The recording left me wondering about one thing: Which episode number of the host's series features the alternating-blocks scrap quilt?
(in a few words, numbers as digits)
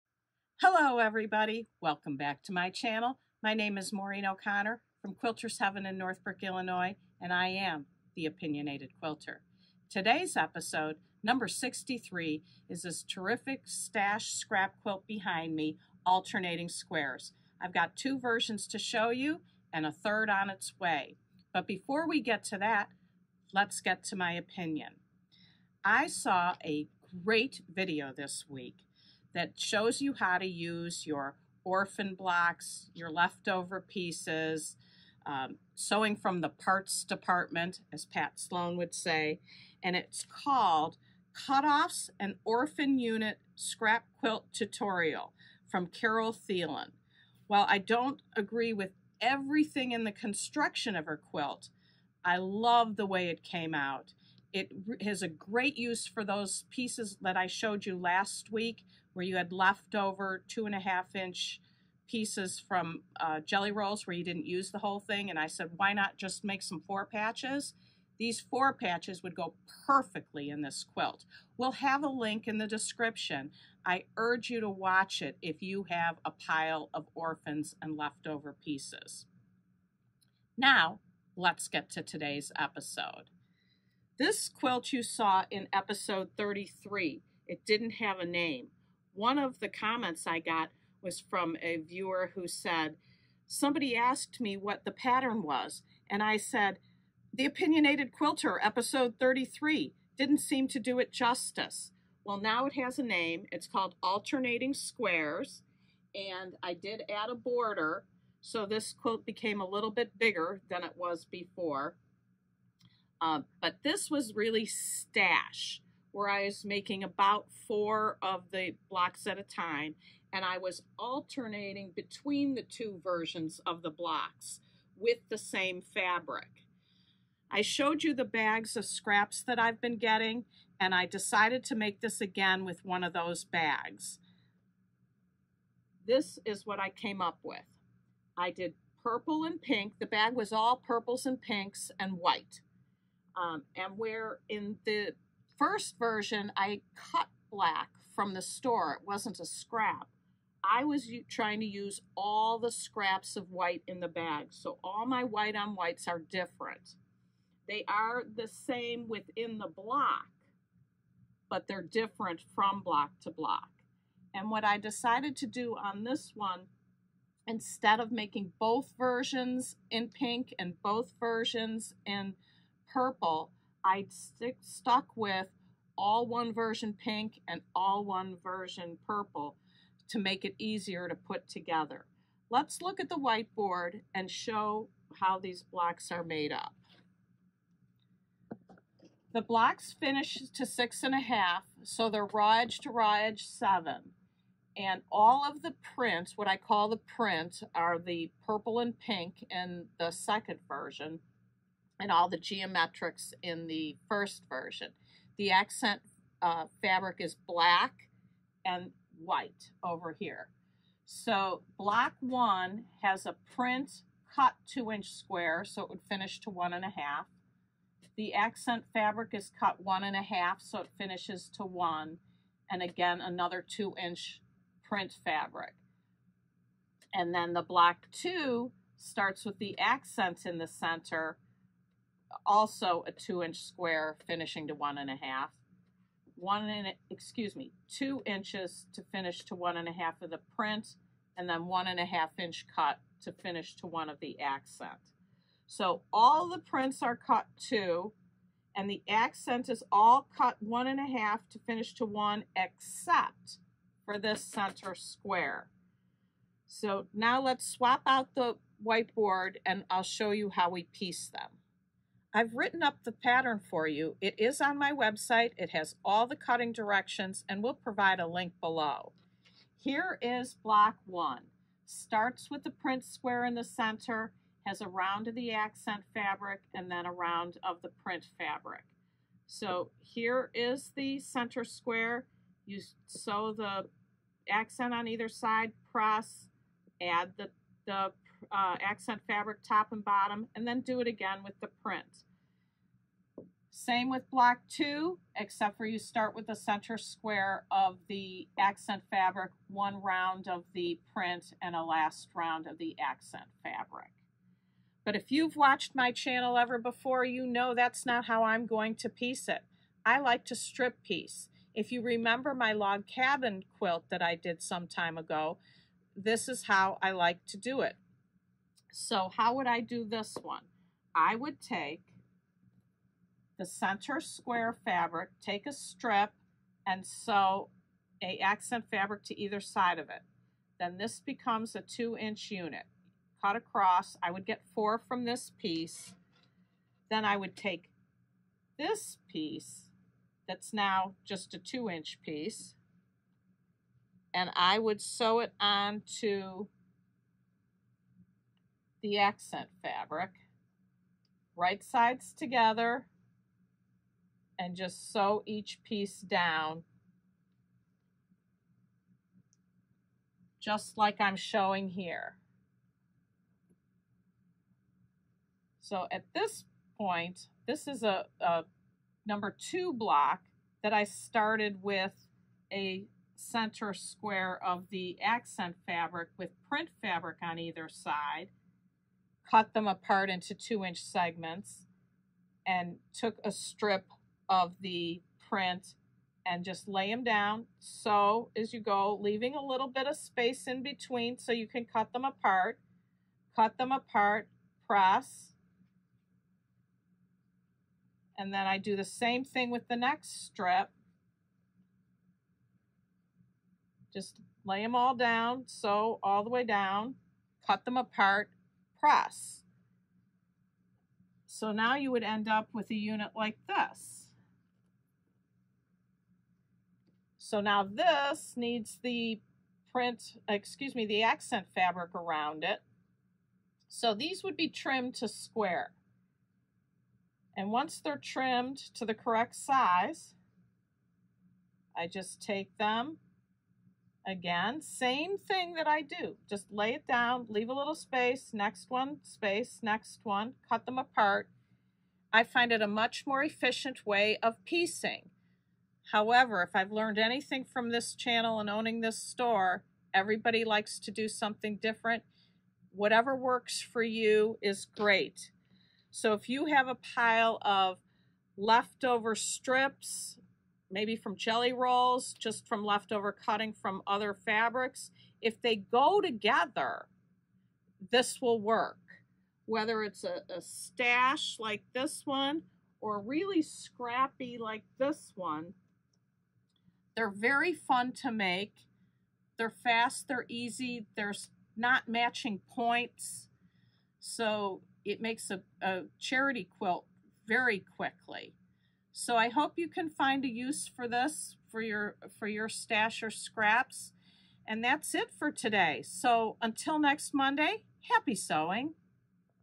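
63.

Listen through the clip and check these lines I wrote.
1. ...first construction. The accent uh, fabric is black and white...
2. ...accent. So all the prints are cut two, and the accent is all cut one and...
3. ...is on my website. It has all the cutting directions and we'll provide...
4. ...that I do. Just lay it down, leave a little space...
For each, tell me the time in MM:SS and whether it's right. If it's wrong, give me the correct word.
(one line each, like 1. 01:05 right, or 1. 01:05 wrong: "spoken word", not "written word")
1. 03:24 wrong: "version", not "construction"
2. 04:04 right
3. 04:24 right
4. 07:15 right.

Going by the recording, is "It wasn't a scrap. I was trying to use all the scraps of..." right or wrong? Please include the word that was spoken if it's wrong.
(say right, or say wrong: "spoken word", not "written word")
right.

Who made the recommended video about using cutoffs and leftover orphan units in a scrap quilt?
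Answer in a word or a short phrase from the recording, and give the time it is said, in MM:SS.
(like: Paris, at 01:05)
Carol Thielen, at 00:45.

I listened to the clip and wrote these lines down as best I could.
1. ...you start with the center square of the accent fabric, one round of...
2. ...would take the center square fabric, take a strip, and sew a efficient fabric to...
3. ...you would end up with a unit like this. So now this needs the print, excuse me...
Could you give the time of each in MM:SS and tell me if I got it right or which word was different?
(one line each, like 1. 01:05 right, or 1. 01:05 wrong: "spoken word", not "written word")
1. 04:55 right
2. 05:21 wrong: "accent", not "efficient"
3. 06:51 right.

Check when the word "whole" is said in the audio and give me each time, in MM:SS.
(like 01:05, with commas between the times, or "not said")
01:04.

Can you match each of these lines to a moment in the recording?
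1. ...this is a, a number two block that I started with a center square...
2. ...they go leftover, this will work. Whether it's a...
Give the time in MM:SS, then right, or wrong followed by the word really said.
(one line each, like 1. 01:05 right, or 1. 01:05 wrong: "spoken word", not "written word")
1. 06:07 right
2. 07:45 wrong: "together", not "leftover".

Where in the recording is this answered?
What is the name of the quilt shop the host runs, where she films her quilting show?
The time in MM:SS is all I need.
00:05.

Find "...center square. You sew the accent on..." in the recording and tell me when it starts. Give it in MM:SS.
04:41.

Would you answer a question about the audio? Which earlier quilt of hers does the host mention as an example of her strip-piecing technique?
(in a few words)
Log cabin quilt.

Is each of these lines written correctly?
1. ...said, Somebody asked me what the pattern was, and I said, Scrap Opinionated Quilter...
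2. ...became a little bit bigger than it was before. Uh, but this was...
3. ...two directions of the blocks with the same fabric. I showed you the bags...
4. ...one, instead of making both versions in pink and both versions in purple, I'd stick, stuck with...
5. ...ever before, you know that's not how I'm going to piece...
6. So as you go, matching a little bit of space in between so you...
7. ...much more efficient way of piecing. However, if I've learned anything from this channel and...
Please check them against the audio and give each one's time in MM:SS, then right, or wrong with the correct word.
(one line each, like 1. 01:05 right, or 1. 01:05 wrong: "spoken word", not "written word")
1. 01:32 wrong: "The", not "Scrap"
2. 01:49 right
3. 02:02 wrong: "versions", not "directions"
4. 02:46 right
5. 05:06 right
6. 06:27 wrong: "leaving", not "matching"
7. 07:22 right.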